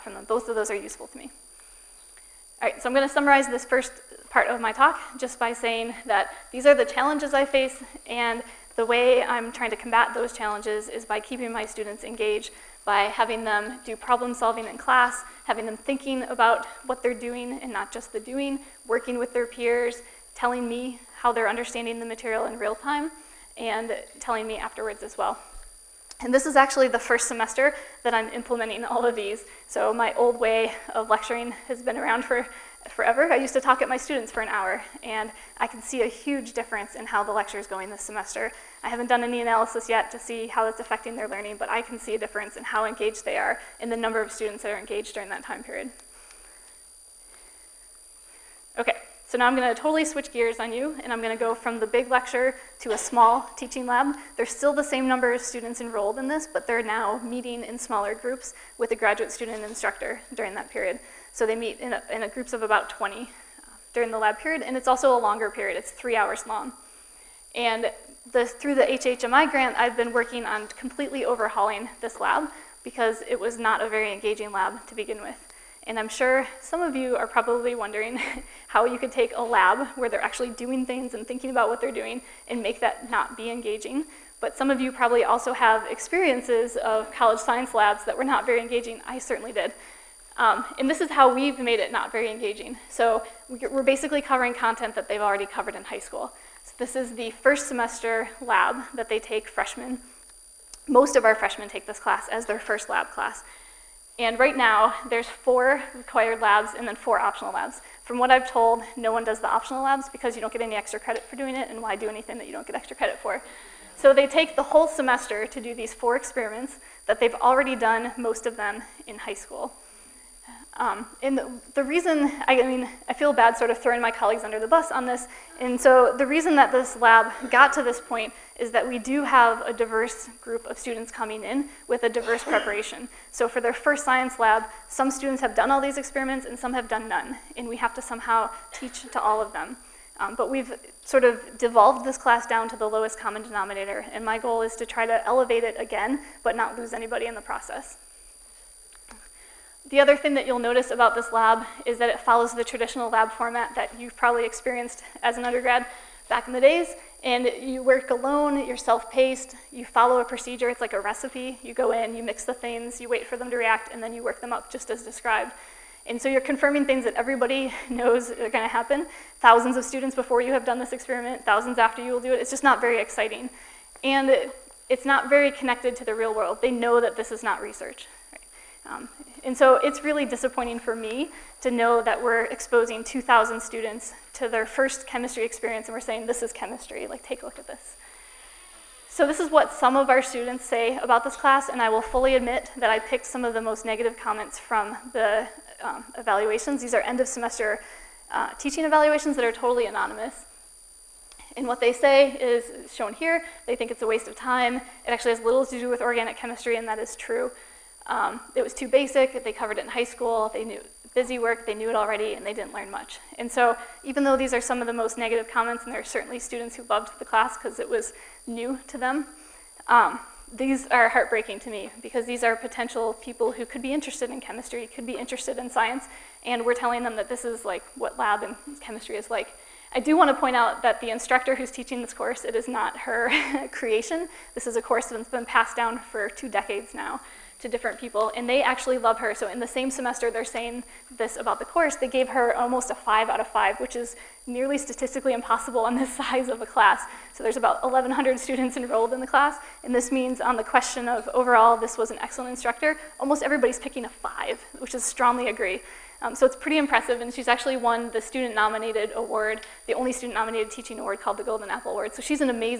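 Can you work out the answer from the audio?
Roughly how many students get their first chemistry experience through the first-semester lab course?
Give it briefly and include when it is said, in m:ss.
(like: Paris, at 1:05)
2,000, at 3:03.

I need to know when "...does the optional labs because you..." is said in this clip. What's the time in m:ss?
1:49.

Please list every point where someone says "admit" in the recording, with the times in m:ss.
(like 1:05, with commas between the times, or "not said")
3:12.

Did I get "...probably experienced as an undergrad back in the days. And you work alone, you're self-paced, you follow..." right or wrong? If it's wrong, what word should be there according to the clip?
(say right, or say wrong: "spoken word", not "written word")
right.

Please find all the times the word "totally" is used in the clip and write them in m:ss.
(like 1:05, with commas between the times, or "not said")
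0:49, 3:19.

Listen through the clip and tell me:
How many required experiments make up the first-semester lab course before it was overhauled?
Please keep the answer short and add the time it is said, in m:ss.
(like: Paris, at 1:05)
4, at 1:45.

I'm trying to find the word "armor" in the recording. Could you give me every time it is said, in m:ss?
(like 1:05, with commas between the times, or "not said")
not said.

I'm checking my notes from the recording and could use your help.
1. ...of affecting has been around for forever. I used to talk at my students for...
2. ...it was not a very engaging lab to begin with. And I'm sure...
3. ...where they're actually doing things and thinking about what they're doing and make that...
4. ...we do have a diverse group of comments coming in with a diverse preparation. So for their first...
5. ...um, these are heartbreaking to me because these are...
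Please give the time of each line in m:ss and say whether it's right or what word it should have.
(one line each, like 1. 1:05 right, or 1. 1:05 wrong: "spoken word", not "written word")
1. 0:30 wrong: "lecturing", not "affecting"
2. 1:13 right
3. 1:19 right
4. 2:08 wrong: "students", not "comments"
5. 3:39 right.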